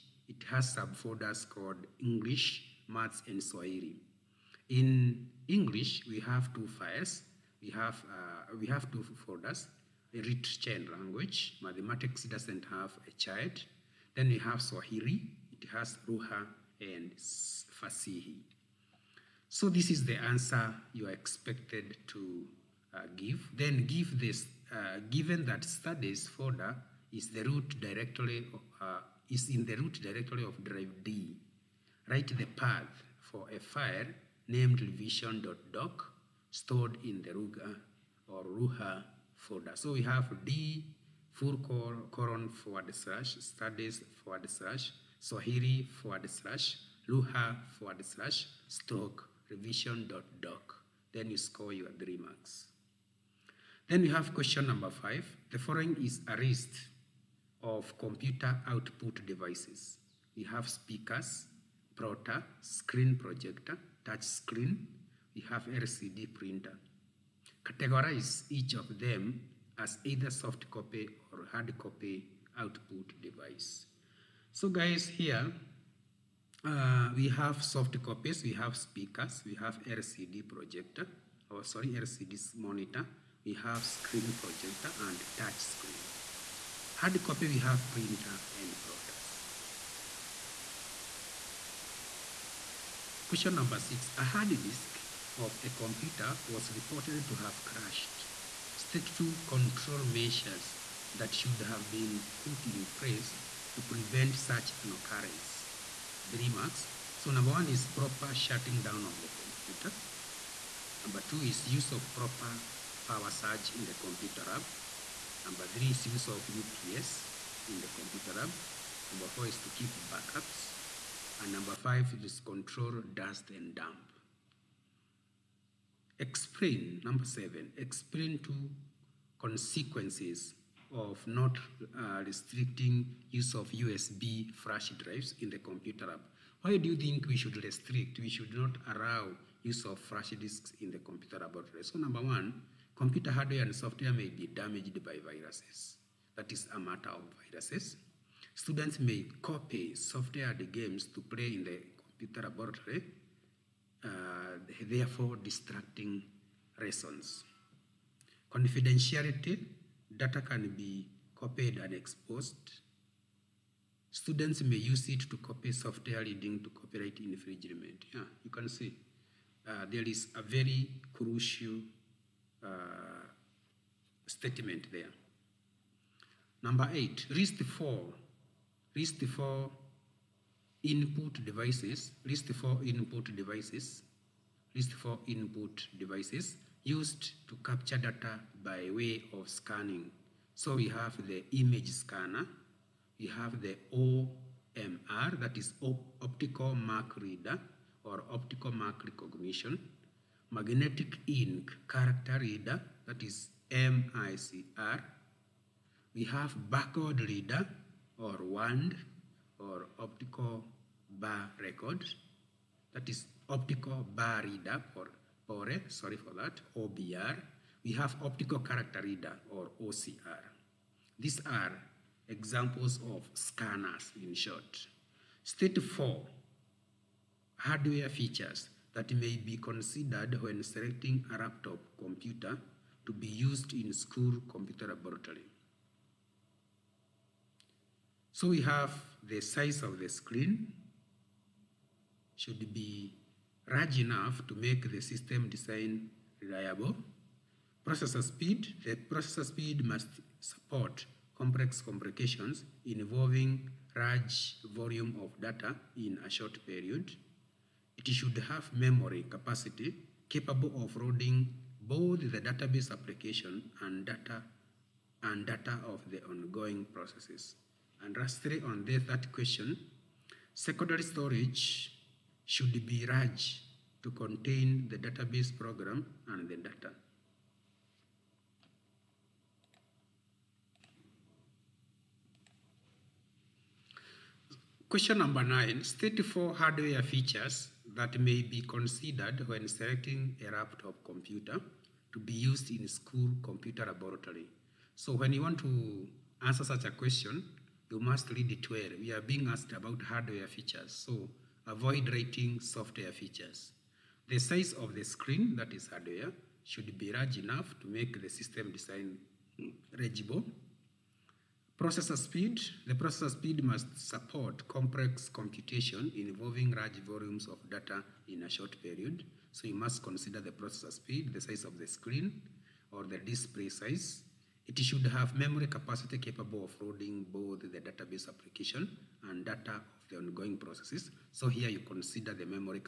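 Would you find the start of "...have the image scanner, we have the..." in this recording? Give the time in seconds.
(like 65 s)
190 s.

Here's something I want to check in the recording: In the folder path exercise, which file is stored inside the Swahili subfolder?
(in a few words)
revision.doc.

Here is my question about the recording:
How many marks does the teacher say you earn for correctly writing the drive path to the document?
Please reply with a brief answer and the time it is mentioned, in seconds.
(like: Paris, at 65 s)
3, at 51 s.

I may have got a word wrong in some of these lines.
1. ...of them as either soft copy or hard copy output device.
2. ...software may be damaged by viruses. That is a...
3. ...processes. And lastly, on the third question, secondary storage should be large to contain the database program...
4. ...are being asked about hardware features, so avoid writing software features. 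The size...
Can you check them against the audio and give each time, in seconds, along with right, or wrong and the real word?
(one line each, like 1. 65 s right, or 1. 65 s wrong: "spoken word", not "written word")
1. 68 s right
2. 143 s right
3. 266 s right
4. 299 s right.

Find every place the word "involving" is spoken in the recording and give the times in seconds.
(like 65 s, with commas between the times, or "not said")
252 s, 316 s.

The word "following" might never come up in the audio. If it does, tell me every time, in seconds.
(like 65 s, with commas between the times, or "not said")
55 s.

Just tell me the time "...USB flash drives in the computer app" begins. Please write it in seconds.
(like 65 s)
133 s.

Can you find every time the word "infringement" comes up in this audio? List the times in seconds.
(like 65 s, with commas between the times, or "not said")
167 s.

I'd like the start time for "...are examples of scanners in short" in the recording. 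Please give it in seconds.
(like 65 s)
221 s.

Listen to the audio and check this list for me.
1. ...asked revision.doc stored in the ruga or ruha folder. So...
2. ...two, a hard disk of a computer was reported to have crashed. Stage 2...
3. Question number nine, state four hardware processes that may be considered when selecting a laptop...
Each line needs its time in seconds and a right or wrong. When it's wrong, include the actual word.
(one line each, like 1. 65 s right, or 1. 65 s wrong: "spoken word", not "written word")
1. 34 s wrong: "named", not "asked"
2. 93 s wrong: "six", not "two"
3. 284 s wrong: "features", not "processes".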